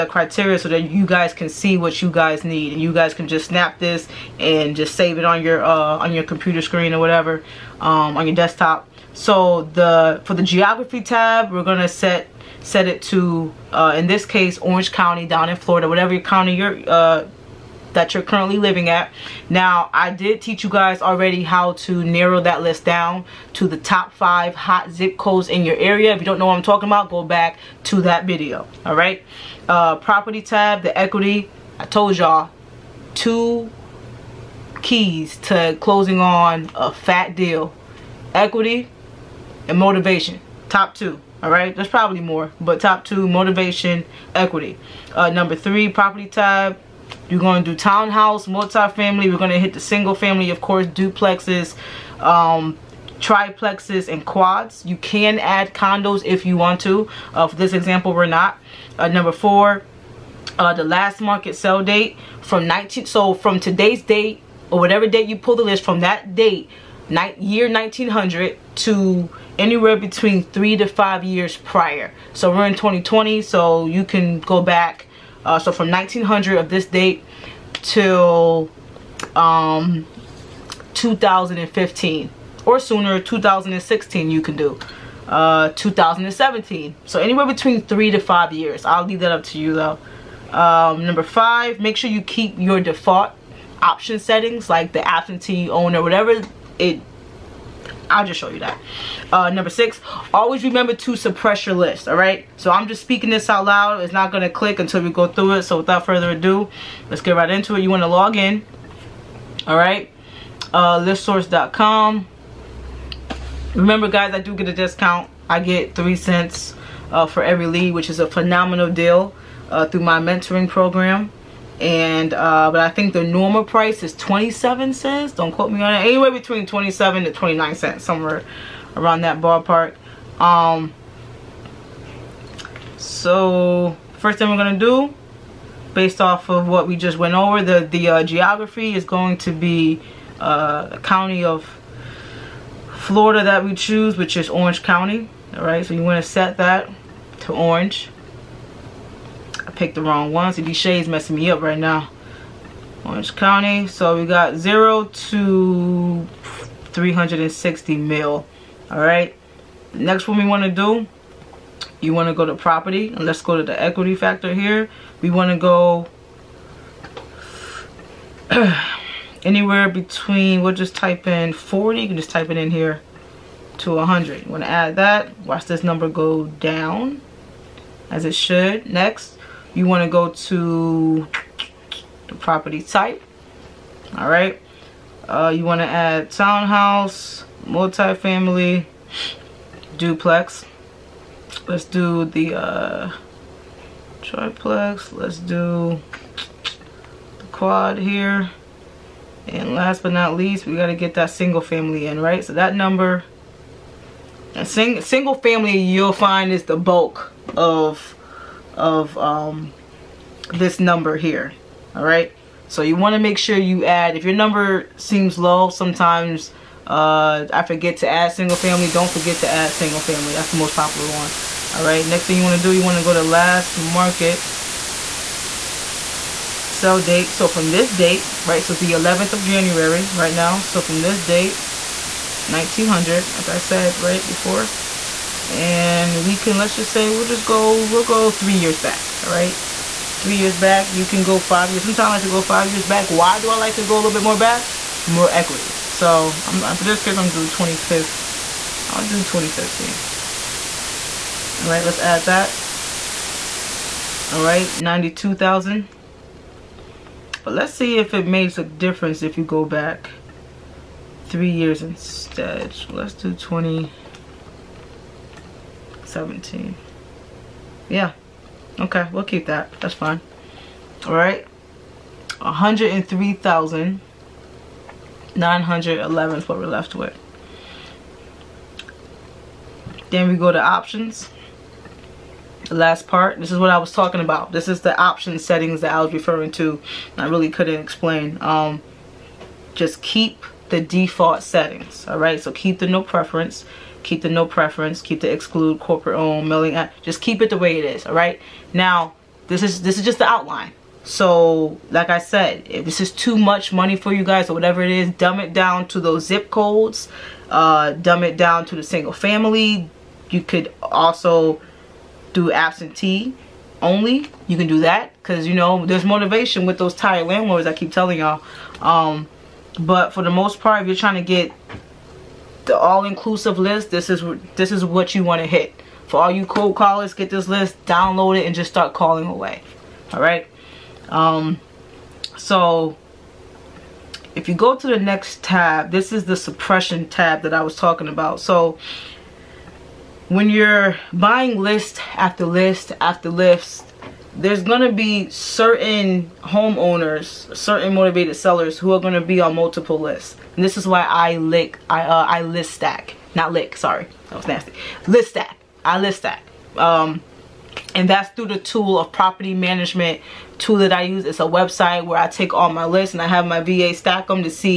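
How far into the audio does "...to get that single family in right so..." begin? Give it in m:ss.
3:20.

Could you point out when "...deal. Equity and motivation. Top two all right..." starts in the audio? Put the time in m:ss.
0:37.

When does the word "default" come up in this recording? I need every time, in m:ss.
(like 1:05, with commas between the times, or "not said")
1:32, 4:50.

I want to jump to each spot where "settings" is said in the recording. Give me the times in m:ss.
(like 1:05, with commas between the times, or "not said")
1:34, 4:45, 4:51.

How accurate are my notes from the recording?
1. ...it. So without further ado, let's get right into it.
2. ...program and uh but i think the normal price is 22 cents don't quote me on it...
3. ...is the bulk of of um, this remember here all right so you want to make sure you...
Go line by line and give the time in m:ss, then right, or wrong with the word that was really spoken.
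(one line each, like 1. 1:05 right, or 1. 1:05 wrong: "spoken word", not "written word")
1. 1:45 right
2. 2:00 wrong: "27", not "22"
3. 3:26 wrong: "number", not "remember".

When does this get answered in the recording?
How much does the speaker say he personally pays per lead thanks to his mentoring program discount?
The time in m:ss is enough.
1:55.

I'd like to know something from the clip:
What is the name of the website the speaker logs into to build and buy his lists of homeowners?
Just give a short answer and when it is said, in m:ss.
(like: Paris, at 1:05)
listsource.com, at 1:50.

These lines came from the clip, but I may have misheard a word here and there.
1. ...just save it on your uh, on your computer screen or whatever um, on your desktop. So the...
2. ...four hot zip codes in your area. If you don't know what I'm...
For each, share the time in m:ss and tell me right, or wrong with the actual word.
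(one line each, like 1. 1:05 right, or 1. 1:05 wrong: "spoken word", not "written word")
1. 0:04 right
2. 0:24 wrong: "five", not "four".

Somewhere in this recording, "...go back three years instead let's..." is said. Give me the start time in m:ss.
4:19.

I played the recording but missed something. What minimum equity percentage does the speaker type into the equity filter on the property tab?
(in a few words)
40.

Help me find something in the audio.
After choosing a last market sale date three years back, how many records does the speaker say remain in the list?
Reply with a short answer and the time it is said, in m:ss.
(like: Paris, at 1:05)
103,911, at 4:32.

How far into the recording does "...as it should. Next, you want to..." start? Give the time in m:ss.
2:58.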